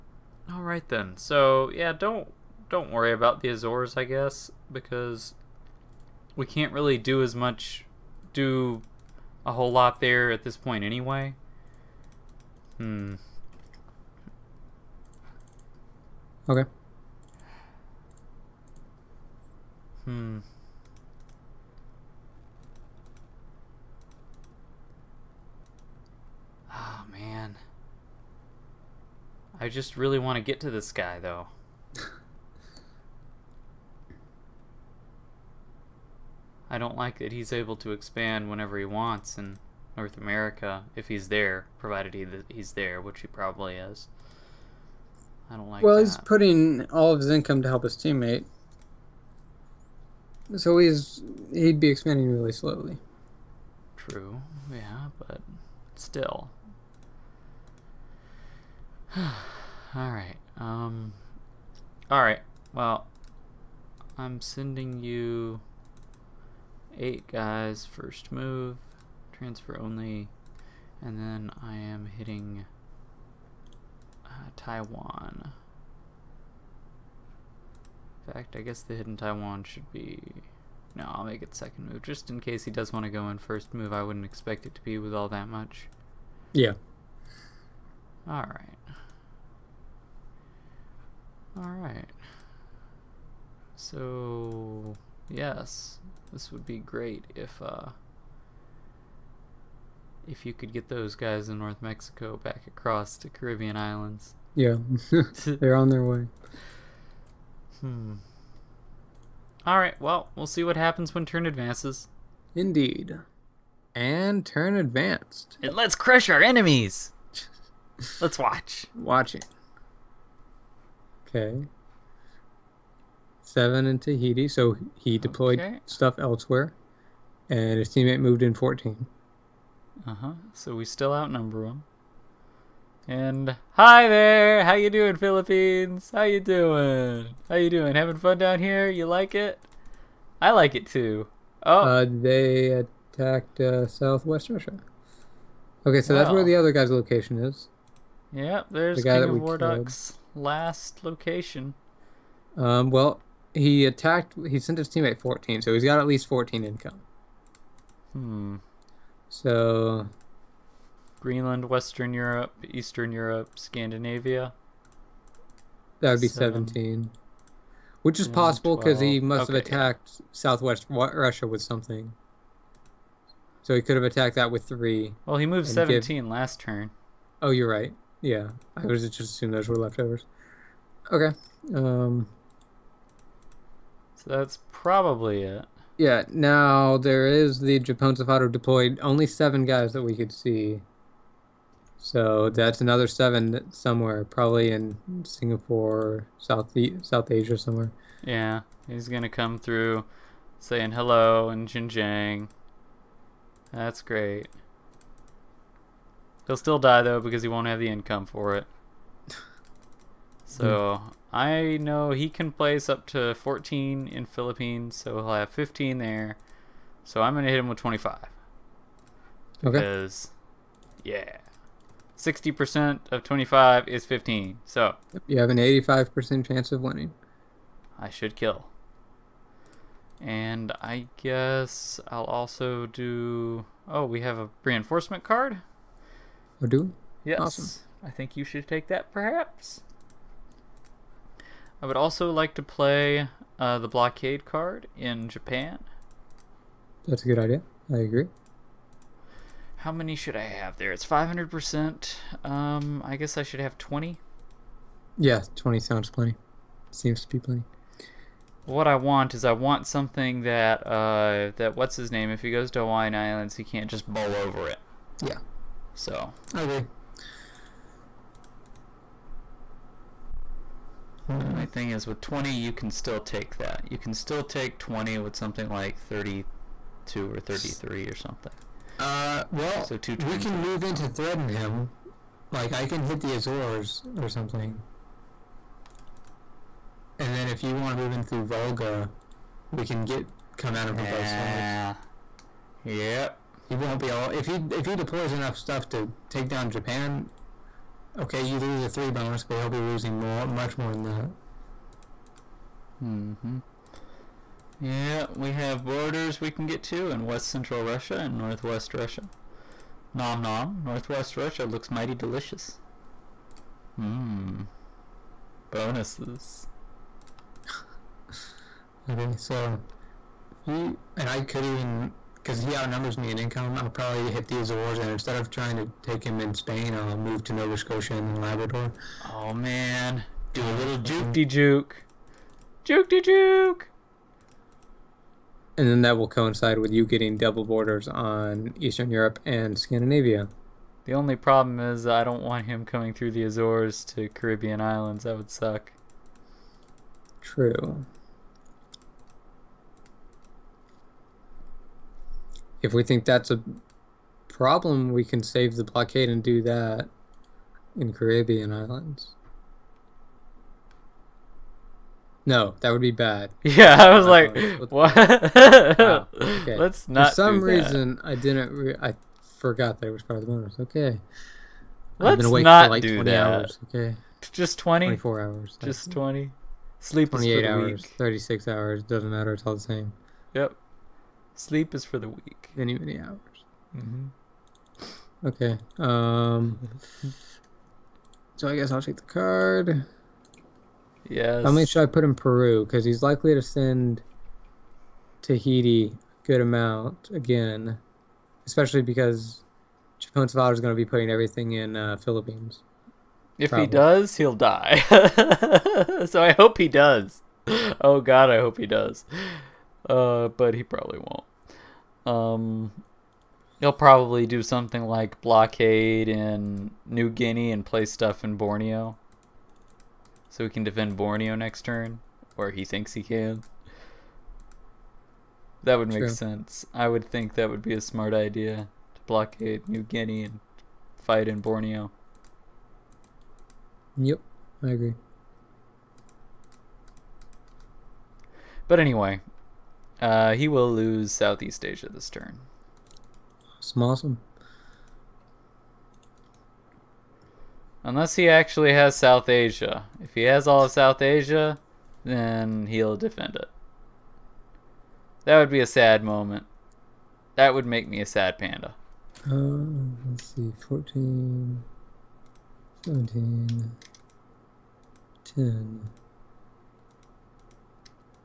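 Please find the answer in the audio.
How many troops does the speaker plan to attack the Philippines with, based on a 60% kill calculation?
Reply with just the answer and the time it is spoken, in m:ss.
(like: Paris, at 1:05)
25, at 3:37.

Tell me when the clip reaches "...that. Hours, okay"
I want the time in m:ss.
6:13.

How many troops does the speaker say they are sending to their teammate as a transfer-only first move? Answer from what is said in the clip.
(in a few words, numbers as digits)
8.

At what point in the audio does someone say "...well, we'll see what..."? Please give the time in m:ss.
1:49.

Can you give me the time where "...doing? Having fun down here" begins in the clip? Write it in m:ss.
2:17.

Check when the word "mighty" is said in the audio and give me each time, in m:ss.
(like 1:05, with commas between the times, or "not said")
5:11.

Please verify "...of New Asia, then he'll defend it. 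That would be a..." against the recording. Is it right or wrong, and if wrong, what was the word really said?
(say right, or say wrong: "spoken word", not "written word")
wrong: "South", not "New".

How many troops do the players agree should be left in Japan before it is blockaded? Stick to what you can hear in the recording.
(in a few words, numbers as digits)
20.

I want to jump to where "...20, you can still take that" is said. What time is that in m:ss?
4:32.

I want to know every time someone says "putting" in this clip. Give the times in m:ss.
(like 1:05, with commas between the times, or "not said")
0:46, 6:41.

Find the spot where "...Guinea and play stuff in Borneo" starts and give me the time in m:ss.
6:57.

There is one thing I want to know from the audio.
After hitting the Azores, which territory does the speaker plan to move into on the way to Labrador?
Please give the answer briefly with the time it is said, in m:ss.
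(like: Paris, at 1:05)
Nova Scotia, at 5:27.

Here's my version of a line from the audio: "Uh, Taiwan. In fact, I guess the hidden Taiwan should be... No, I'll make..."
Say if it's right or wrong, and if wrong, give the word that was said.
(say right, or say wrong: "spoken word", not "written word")
right.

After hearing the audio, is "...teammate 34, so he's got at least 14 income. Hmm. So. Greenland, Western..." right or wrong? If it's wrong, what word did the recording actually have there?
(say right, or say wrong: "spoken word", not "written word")
wrong: "14", not "34".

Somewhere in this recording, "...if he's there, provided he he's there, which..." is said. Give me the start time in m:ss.
0:40.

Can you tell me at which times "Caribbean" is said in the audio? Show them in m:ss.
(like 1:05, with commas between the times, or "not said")
1:43, 5:44, 5:58.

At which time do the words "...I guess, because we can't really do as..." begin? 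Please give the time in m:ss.
0:03.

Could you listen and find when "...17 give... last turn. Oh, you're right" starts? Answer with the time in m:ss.
2:55.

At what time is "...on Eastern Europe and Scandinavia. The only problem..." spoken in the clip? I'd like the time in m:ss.
5:38.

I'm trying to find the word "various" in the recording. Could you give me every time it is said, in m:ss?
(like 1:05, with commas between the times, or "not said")
not said.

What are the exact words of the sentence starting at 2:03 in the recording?
Seven in Tahiti, so he deployed okay.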